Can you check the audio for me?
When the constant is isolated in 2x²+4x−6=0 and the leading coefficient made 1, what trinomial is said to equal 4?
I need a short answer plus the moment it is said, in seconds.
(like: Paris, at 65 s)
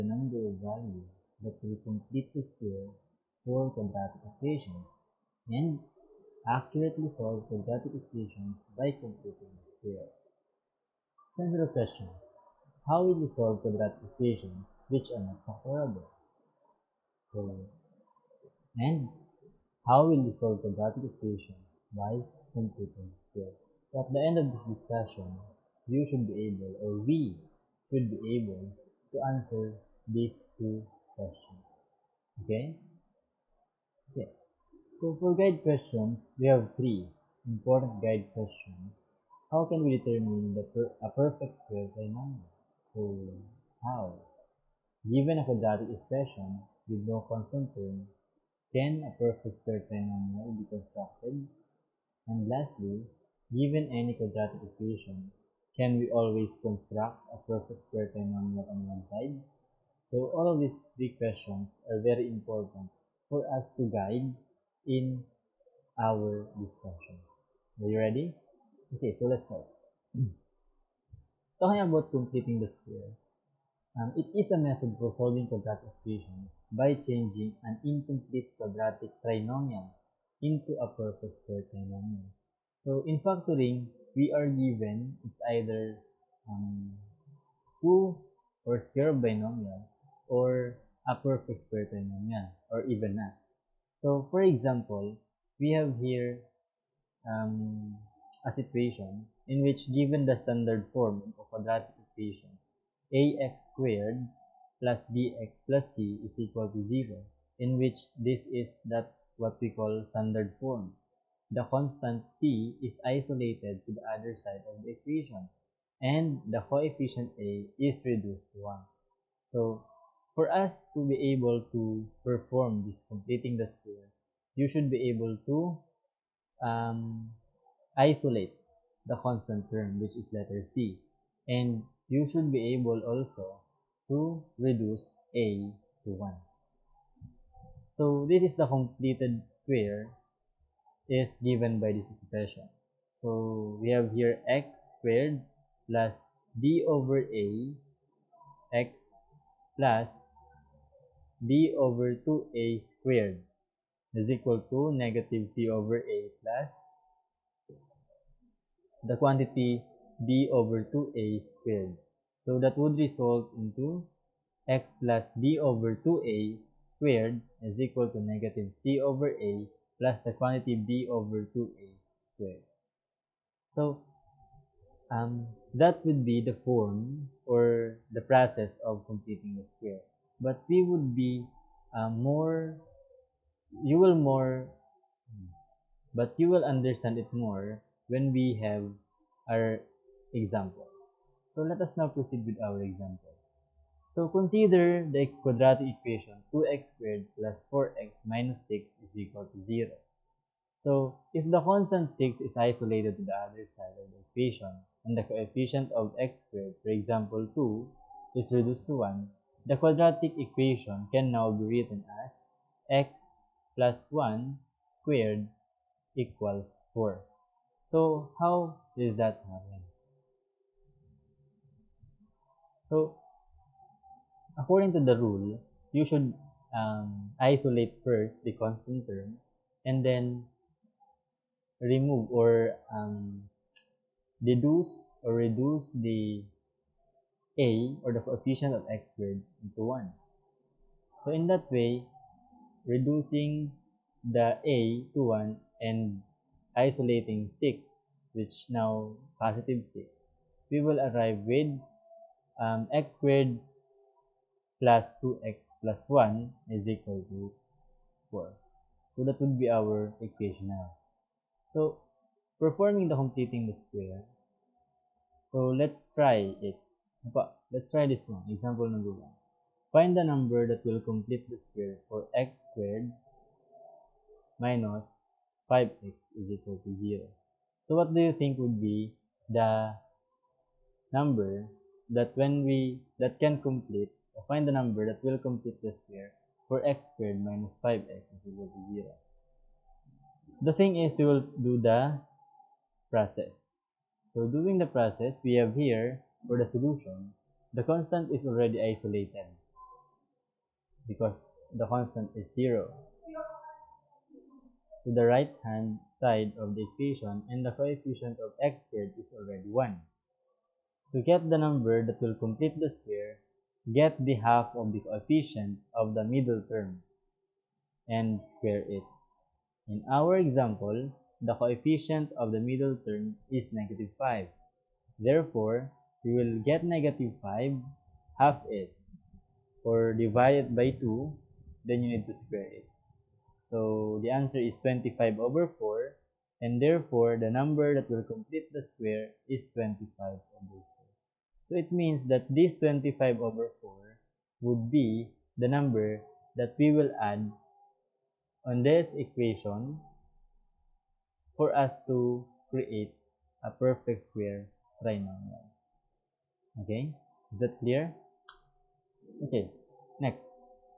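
x squared plus 2x plus 1, at 252 s.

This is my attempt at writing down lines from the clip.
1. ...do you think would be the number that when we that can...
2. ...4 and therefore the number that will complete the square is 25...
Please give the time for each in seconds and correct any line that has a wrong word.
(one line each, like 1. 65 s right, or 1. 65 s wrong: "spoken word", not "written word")
1. 278 s right
2. 335 s right.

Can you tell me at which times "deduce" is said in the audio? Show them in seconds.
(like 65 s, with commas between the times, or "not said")
234 s.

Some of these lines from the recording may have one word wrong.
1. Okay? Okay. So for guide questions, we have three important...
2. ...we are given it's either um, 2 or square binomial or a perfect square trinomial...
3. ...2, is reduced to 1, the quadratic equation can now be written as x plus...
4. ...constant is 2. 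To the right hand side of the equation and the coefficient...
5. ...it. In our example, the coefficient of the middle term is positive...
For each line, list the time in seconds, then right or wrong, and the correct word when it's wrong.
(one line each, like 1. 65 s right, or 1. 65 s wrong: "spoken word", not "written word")
1. 32 s right
2. 84 s right
3. 207 s right
4. 301 s wrong: "0", not "2"
5. 318 s wrong: "negative", not "positive".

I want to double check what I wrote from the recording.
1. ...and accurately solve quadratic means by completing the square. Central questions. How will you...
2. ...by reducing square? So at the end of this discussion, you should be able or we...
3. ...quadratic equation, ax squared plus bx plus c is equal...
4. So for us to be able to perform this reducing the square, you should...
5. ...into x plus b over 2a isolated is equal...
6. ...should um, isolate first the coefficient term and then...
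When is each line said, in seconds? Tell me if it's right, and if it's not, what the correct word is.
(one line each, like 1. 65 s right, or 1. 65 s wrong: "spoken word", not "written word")
1. 5 s wrong: "equations", not "means"
2. 21 s wrong: "simplifying", not "reducing"
3. 101 s right
4. 119 s wrong: "completing", not "reducing"
5. 163 s wrong: "squared", not "isolated"
6. 226 s wrong: "constant", not "coefficient".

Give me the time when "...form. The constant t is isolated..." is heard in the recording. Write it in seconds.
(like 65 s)
110 s.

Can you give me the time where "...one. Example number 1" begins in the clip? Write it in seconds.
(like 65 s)
268 s.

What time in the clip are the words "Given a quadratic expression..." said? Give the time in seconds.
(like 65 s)
45 s.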